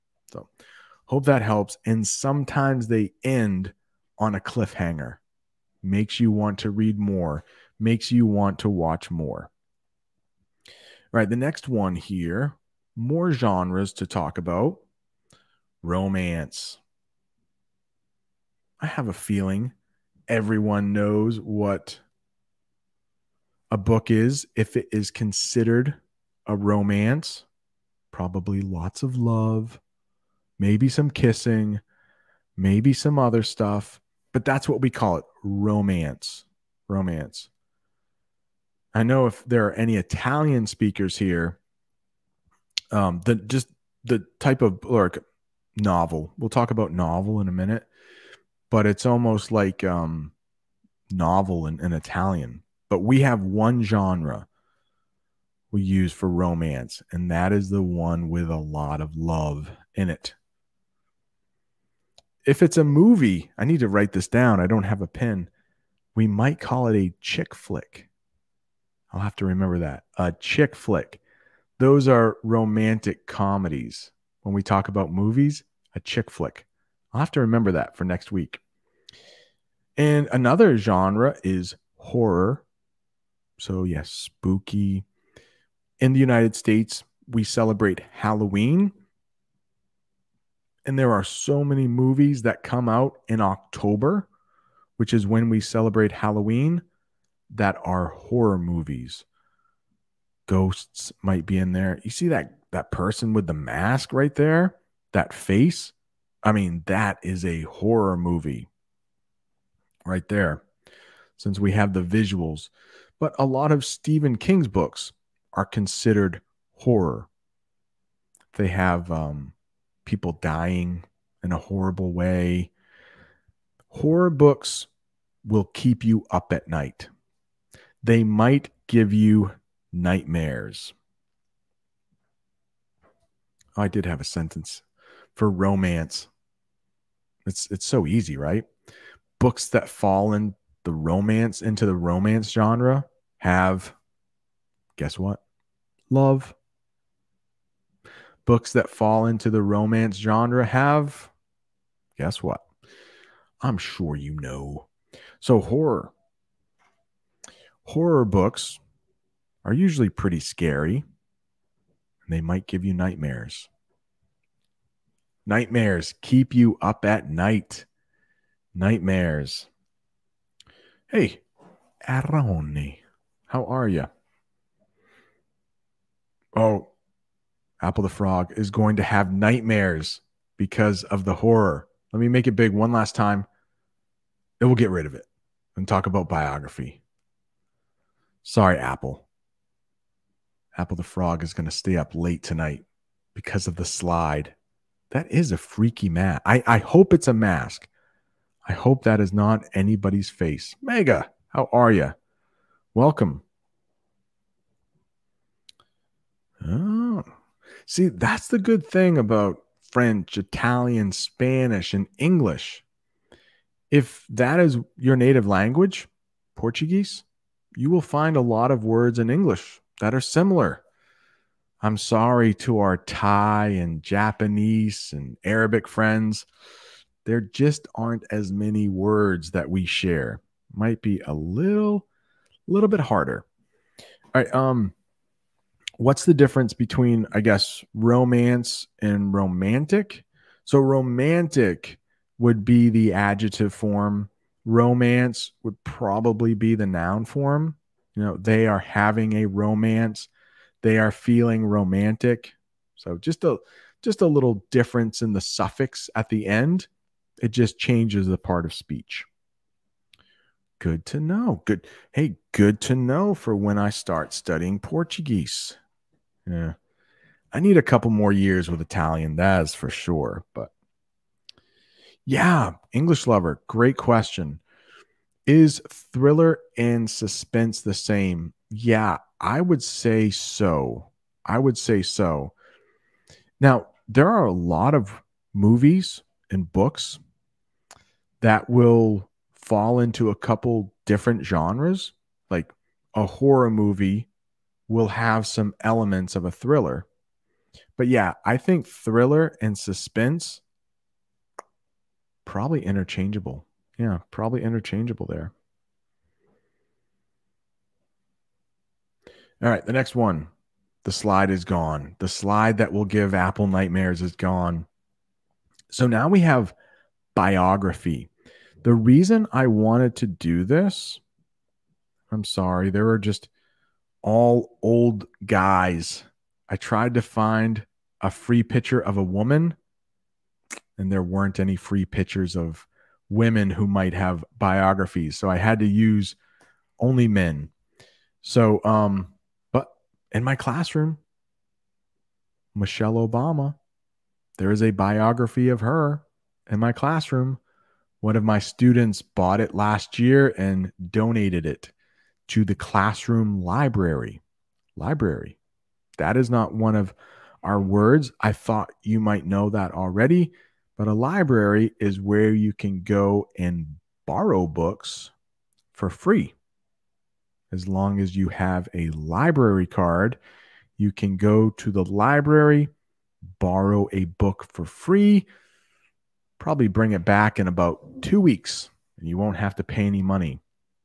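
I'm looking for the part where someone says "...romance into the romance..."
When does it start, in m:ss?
2:20.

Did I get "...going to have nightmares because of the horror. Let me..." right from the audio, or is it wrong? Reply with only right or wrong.
right.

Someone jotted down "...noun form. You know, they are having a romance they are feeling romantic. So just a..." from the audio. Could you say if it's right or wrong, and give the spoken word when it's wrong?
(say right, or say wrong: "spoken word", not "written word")
right.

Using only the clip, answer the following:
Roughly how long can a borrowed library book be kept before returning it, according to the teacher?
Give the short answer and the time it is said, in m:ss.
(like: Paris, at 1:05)
2 weeks, at 6:18.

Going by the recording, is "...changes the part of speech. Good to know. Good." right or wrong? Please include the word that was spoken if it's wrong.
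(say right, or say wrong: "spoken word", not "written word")
right.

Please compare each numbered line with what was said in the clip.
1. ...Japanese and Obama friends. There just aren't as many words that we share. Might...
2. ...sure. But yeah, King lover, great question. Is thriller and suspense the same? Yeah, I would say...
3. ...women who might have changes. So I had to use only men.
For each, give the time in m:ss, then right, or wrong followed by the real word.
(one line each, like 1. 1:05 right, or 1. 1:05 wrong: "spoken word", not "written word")
1. 3:44 wrong: "Arabic", not "Obama"
2. 4:29 wrong: "English", not "King"
3. 5:33 wrong: "biographies", not "changes".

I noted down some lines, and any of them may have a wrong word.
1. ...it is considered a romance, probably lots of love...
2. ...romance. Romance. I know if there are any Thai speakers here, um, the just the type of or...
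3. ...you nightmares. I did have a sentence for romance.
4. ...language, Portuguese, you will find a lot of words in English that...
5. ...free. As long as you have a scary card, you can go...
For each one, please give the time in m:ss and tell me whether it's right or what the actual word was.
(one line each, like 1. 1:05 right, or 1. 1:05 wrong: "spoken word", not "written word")
1. 0:24 right
2. 0:35 wrong: "Italian", not "Thai"
3. 2:09 right
4. 3:35 right
5. 6:06 wrong: "library", not "scary".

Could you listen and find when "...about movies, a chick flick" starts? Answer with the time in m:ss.
1:14.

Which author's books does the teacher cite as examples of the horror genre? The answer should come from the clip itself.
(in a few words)
Stephen King.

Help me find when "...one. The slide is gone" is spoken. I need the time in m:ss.
5:10.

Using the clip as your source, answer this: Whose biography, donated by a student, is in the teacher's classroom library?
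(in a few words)
Michelle Obama.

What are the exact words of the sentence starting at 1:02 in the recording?
If it's a movie, I need to write this down.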